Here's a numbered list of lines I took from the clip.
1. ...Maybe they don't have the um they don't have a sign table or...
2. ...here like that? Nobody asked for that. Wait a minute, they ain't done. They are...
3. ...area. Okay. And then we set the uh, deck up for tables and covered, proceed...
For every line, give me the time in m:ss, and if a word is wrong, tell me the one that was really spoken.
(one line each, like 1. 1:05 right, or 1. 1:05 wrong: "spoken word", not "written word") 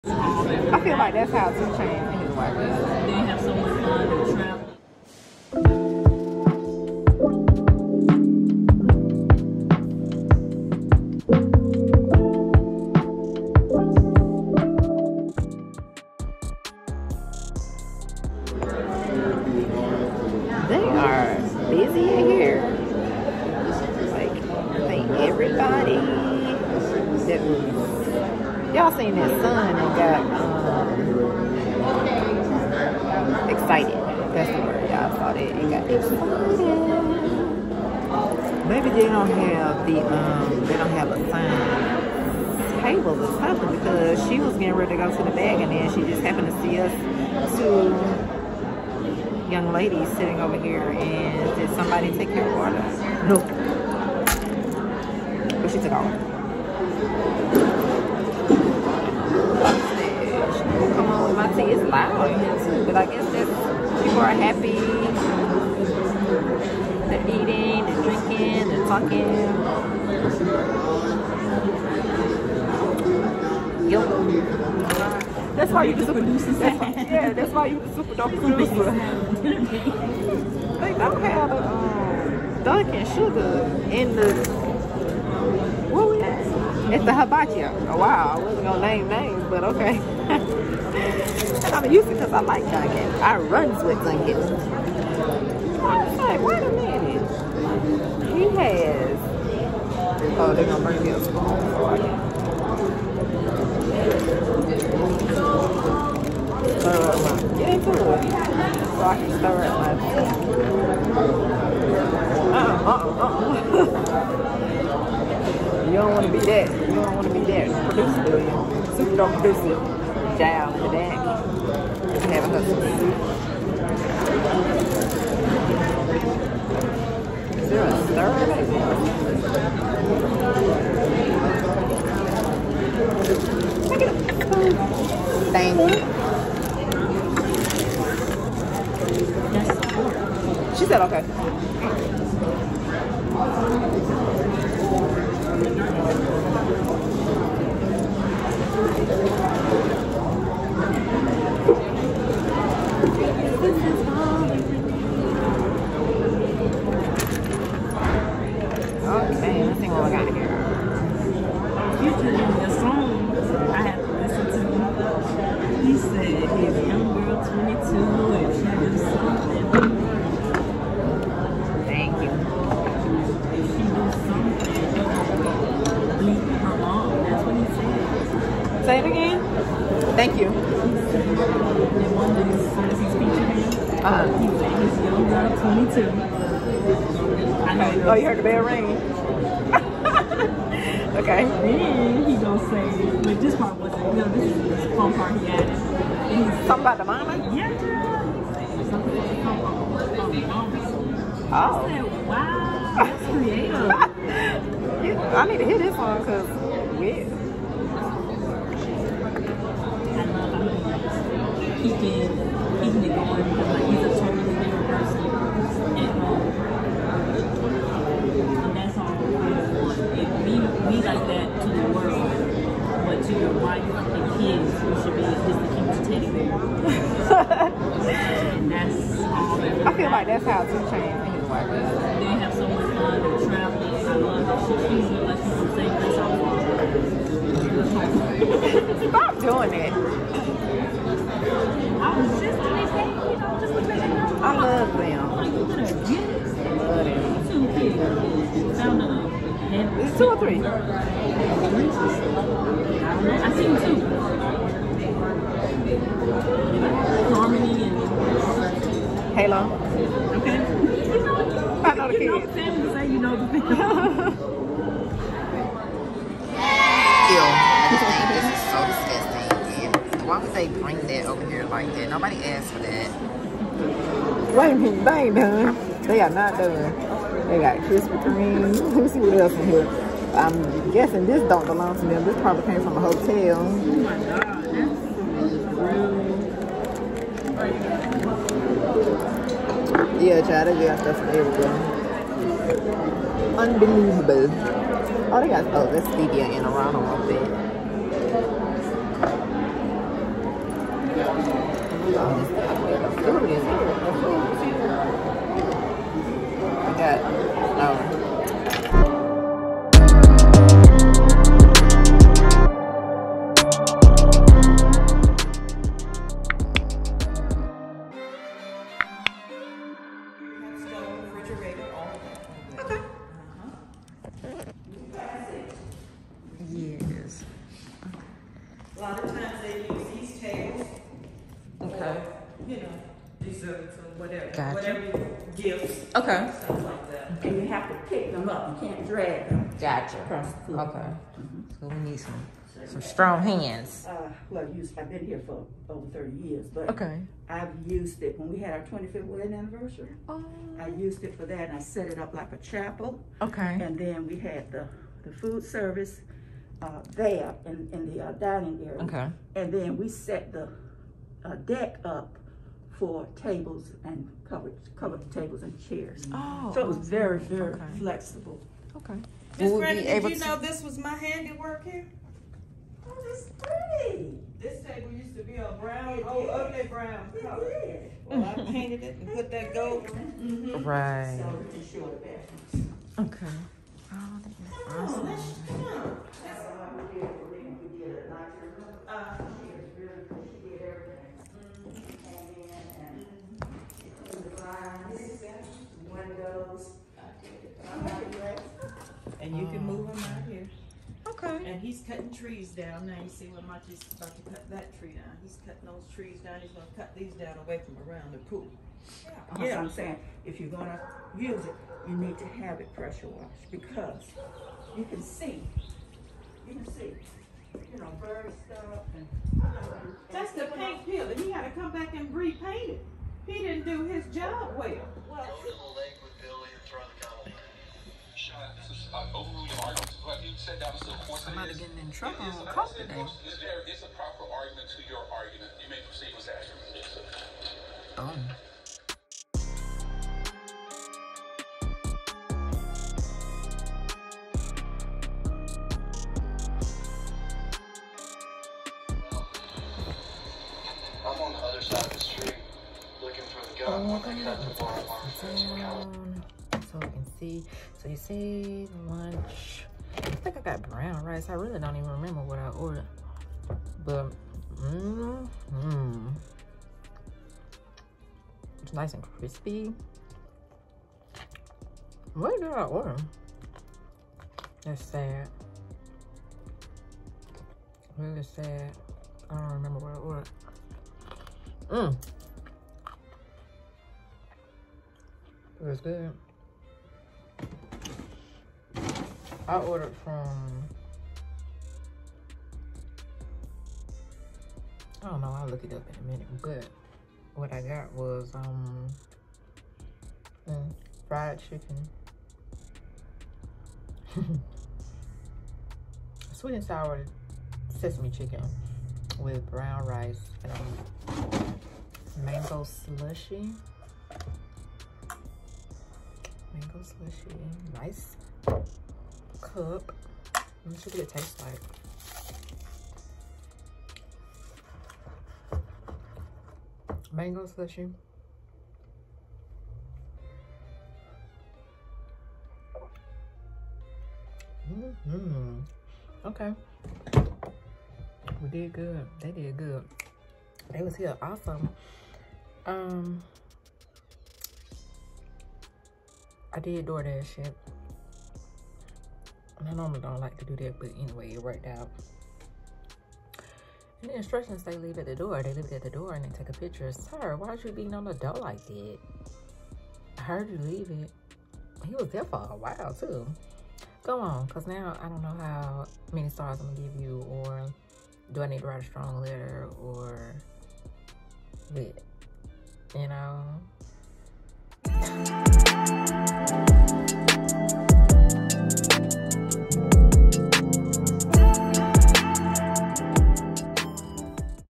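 1. 0:38 right
2. 4:31 right
3. 5:58 wrong: "covered", not "proceed".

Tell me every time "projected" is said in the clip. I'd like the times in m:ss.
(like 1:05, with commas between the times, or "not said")
not said.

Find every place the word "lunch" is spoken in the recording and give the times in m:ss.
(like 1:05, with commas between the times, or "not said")
7:39.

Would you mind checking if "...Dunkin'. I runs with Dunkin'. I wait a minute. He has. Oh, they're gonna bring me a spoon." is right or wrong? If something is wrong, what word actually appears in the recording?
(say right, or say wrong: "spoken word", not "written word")
right.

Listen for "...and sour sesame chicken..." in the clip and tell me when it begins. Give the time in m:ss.
8:26.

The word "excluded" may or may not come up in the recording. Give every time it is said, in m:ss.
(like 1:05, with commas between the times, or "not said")
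not said.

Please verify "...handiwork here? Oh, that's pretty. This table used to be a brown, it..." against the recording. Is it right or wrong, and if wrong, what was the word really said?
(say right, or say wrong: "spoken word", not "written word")
right.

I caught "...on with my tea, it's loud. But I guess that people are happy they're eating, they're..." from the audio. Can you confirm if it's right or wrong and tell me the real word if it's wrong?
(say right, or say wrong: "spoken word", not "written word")
right.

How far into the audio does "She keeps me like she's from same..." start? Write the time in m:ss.
3:54.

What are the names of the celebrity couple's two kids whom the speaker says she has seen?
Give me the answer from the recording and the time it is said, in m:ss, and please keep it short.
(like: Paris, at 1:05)
Harmony and Halo, at 4:17.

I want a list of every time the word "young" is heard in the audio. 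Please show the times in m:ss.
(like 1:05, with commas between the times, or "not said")
0:49, 3:05.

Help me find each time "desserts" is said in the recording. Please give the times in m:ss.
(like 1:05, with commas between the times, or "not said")
5:33.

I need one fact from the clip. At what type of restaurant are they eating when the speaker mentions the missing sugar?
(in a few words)
Hibachi.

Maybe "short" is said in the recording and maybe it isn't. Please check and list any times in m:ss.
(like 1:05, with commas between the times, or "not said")
6:21.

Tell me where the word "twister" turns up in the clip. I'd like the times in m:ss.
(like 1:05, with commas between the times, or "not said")
not said.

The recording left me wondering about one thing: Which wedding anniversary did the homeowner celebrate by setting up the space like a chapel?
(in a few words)
25th.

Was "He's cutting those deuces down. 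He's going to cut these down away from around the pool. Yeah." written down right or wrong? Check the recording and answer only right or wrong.
wrong.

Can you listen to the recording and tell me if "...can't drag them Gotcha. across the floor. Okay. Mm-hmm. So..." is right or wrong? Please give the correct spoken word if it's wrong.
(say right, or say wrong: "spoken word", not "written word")
right.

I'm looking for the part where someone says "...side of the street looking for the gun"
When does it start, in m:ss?
7:31.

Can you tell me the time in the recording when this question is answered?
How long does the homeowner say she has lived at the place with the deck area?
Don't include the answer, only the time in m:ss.
5:45.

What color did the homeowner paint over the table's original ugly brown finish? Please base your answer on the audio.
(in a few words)
Gold.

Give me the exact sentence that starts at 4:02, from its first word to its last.
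I was just doing that, you know, just to let you know.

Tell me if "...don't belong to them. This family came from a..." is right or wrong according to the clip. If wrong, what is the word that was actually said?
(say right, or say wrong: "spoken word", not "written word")
wrong: "probably", not "family".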